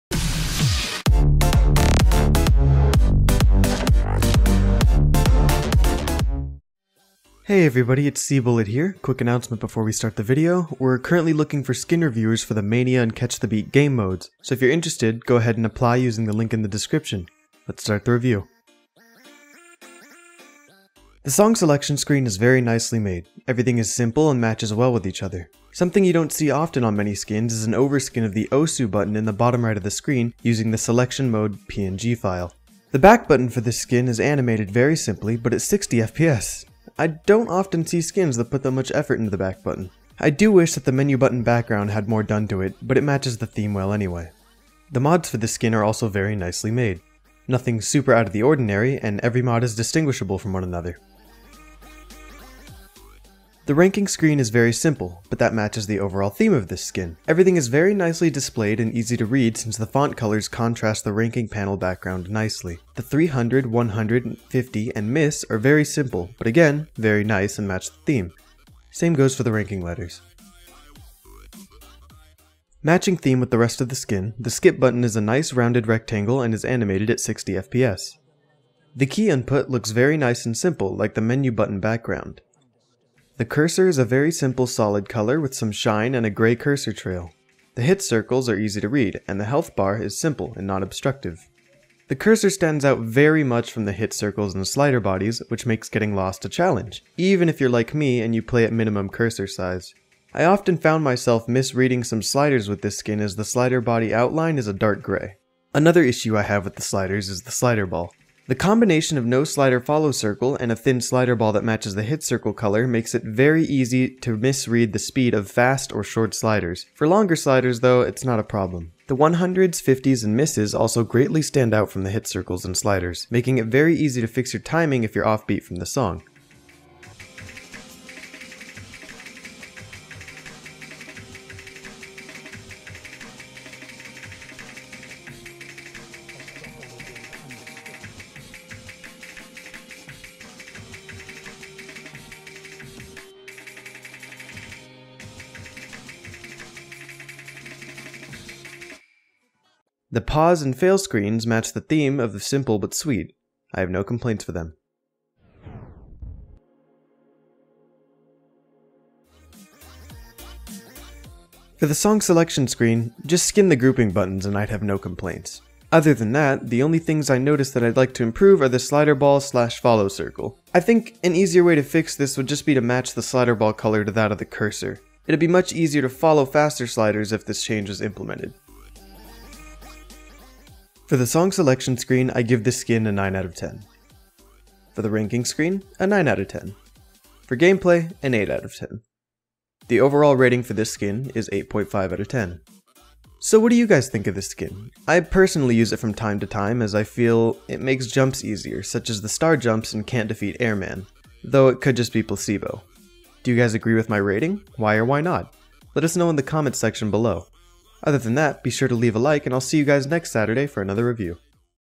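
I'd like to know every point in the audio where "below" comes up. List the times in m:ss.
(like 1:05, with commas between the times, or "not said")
3:27.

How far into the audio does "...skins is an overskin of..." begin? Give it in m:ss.
0:27.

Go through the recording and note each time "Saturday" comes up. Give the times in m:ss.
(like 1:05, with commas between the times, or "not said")
3:30.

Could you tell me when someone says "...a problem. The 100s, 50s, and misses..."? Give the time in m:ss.
1:58.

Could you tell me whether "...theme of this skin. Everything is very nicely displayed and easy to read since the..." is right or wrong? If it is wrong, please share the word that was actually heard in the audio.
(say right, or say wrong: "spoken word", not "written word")
right.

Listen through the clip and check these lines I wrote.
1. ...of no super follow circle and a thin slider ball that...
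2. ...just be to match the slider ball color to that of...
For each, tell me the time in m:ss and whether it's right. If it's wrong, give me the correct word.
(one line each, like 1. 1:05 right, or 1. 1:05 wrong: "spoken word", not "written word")
1. 1:49 wrong: "slider", not "super"
2. 2:52 right.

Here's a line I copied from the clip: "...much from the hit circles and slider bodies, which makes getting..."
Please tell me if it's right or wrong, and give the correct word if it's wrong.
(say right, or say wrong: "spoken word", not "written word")
right.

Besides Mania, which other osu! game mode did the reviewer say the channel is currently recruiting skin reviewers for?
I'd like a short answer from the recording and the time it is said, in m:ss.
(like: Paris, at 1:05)
Catch the Beat, at 0:13.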